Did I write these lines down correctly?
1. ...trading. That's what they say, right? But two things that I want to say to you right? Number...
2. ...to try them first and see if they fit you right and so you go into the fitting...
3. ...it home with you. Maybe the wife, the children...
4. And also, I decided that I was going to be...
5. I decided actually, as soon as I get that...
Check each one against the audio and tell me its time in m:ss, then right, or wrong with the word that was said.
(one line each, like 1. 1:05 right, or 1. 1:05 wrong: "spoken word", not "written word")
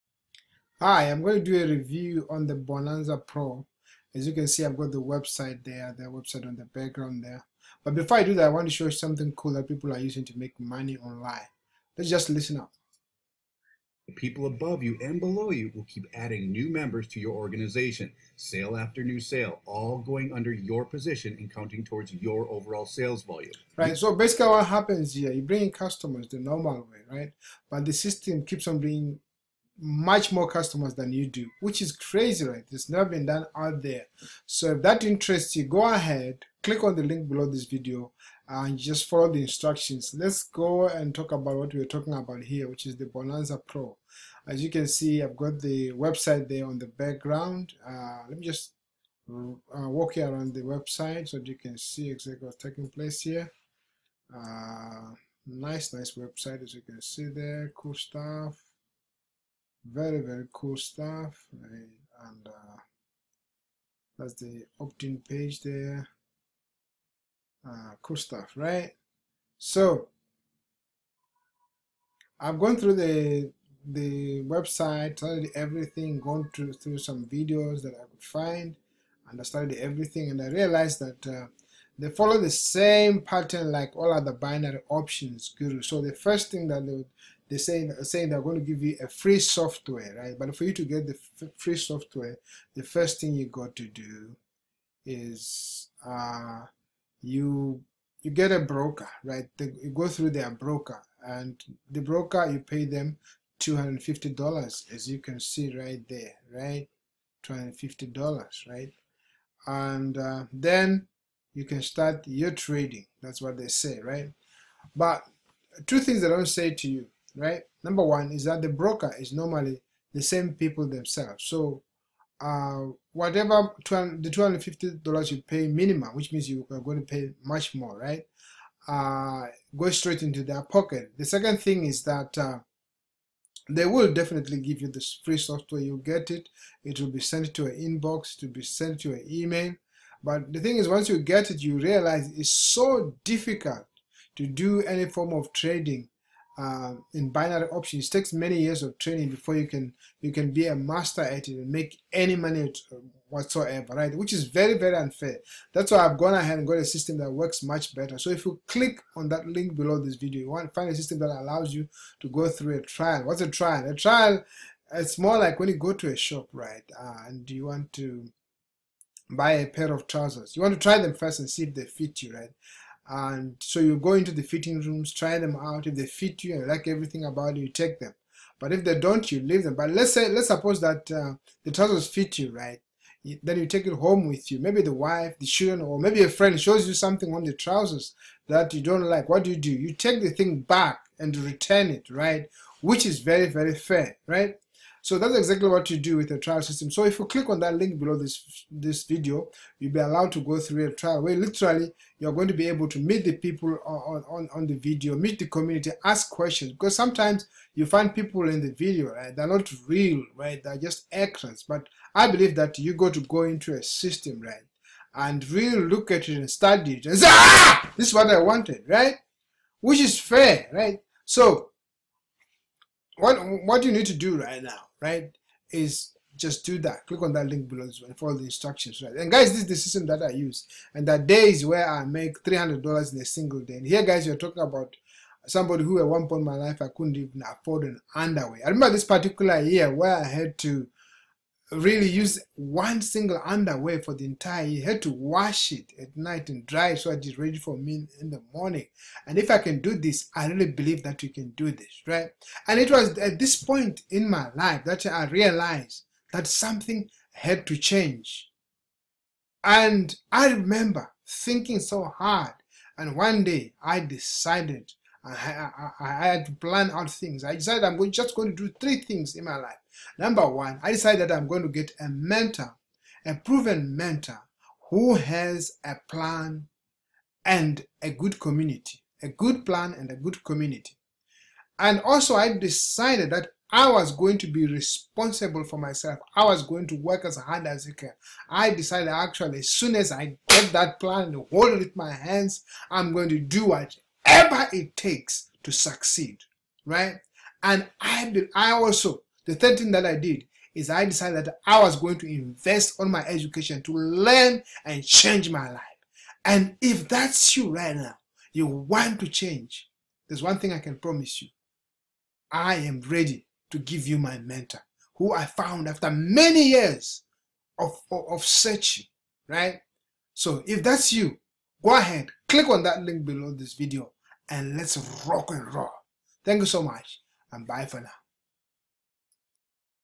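1. 1:52 right
2. 2:50 right
3. 3:03 right
4. 4:41 right
5. 4:48 right.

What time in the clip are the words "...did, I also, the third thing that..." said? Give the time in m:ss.
4:58.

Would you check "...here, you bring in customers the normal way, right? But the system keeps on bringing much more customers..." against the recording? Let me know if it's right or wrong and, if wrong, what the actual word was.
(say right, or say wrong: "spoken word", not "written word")
right.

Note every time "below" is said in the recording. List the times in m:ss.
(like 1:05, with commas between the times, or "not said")
0:15, 0:37, 2:39, 3:17, 3:47, 5:23.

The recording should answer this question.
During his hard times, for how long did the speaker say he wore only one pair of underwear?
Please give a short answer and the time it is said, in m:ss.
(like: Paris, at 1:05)
entire year, at 4:04.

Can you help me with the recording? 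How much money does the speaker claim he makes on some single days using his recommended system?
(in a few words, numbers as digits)
$300.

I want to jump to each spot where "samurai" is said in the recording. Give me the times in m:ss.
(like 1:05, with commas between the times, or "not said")
not said.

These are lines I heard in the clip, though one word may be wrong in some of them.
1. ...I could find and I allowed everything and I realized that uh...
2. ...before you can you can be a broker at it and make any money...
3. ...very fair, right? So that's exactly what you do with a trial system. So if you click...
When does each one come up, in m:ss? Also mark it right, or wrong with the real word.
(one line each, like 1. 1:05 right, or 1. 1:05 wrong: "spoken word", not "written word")
1. 1:17 wrong: "studied", not "allowed"
2. 2:29 wrong: "master", not "broker"
3. 3:13 right.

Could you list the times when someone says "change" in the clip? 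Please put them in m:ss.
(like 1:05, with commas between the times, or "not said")
4:17, 5:05, 5:09.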